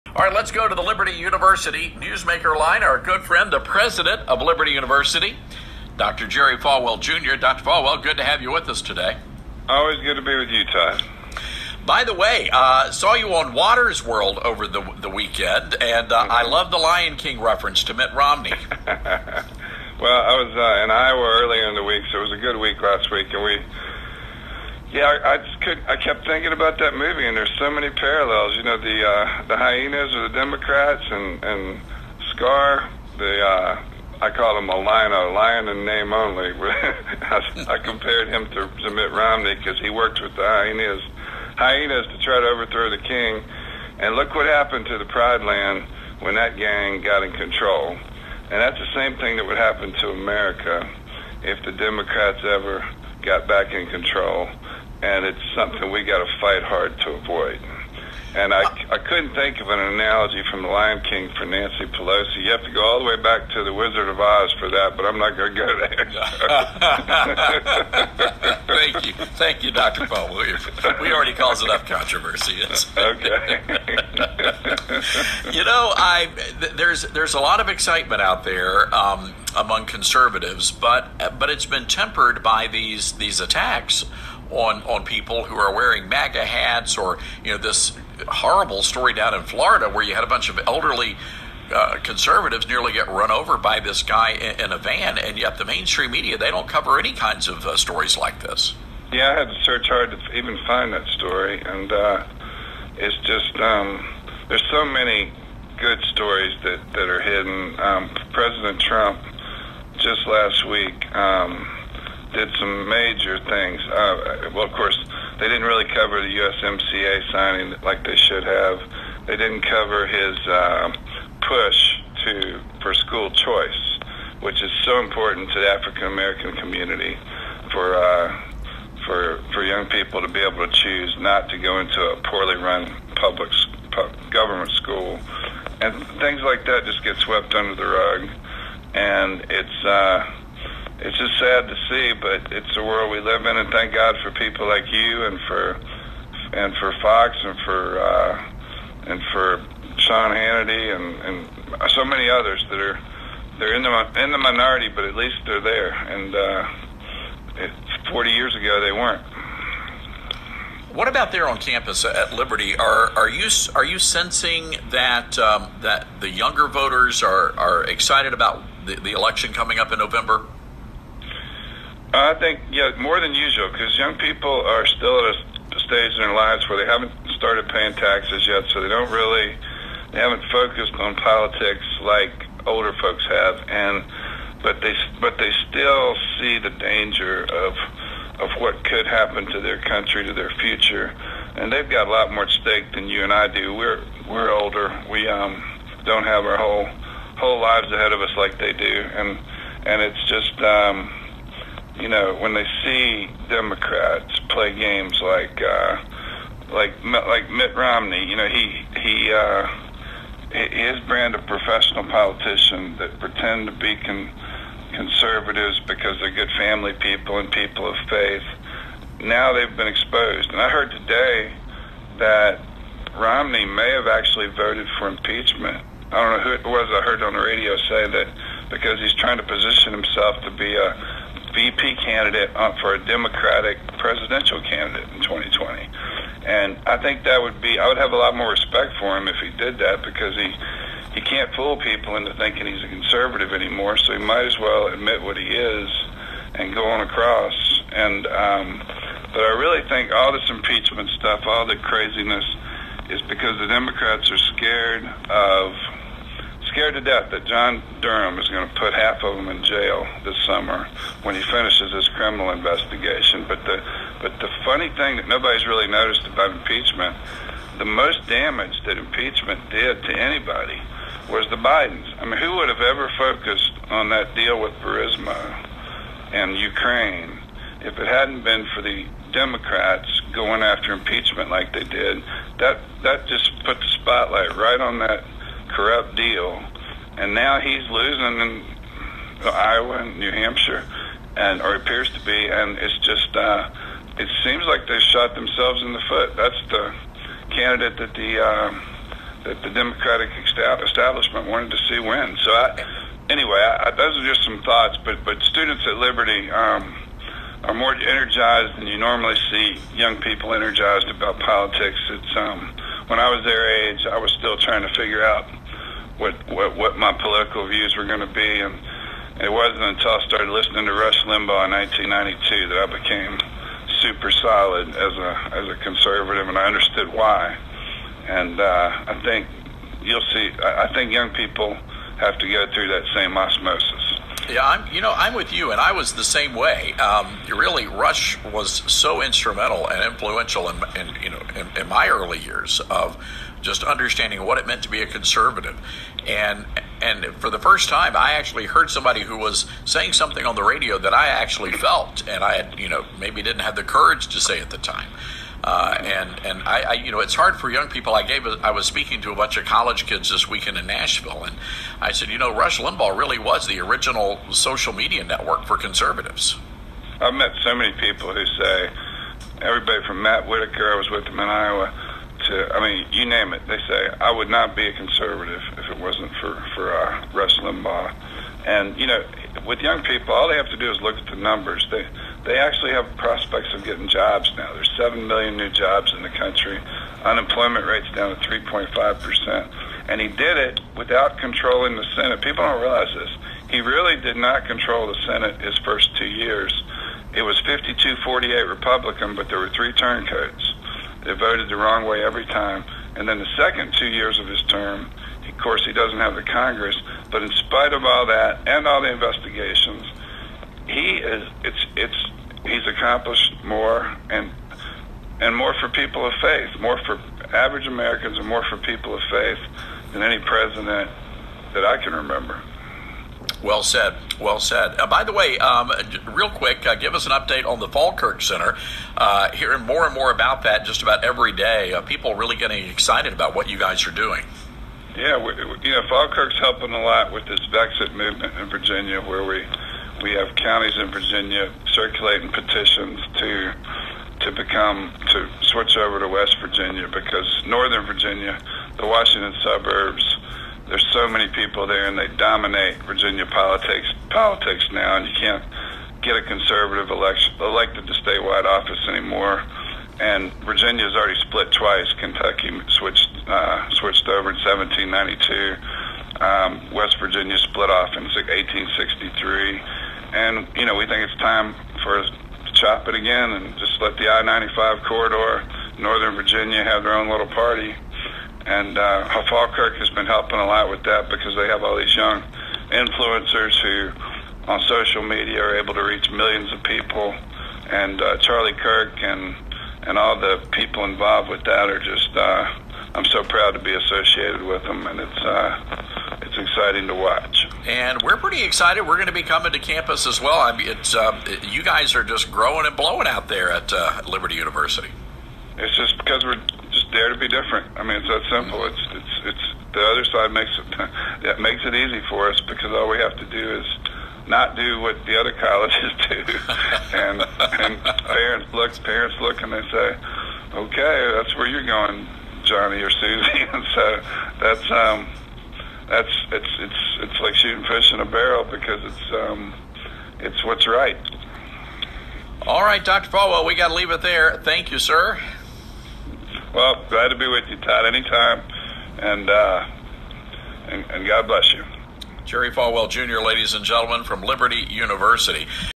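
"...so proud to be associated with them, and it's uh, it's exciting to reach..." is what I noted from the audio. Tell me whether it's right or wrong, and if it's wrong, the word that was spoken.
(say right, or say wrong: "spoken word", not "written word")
wrong: "watch", not "reach".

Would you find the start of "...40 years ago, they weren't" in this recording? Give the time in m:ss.
2:38.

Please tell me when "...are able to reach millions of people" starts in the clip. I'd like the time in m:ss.
8:05.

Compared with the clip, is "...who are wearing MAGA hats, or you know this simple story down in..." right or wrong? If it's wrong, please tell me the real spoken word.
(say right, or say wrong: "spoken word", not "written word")
wrong: "horrible", not "simple".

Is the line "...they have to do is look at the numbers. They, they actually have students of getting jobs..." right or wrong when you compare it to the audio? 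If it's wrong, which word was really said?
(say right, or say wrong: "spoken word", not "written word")
wrong: "prospects", not "students".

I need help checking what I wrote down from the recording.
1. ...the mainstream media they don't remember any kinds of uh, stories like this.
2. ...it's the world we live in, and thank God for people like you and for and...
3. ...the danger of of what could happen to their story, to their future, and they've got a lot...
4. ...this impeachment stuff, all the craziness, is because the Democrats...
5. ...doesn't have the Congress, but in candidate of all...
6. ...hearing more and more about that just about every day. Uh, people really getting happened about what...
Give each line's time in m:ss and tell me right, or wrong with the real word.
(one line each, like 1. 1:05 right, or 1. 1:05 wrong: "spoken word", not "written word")
1. 1:35 wrong: "cover", not "remember"
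2. 2:22 right
3. 3:06 wrong: "country", not "story"
4. 4:10 right
5. 6:45 wrong: "spite", not "candidate"
6. 7:09 wrong: "excited", not "happened".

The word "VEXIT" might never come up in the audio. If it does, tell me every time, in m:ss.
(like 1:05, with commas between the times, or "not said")
7:17.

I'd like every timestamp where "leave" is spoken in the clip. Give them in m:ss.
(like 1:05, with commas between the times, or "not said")
8:53.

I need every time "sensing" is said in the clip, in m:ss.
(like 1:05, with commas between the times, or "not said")
2:43.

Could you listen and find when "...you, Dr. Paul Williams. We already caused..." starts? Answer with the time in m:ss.
1:09.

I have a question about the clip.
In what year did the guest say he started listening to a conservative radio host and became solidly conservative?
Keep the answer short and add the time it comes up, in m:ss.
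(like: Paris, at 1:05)
1992, at 5:21.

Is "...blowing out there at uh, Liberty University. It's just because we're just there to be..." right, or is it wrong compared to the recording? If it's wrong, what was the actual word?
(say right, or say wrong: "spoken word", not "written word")
right.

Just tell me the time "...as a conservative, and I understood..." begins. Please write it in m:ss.
5:25.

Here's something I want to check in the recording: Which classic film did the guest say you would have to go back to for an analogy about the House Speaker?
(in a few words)
The Wizard of Oz.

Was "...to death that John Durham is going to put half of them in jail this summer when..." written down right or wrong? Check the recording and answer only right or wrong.
right.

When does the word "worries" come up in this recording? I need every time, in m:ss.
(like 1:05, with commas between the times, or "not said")
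not said.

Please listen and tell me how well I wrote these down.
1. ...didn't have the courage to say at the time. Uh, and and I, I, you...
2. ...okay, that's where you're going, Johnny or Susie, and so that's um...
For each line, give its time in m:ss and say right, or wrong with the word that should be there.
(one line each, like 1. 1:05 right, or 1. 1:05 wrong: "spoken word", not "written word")
1. 5:53 right
2. 8:40 right.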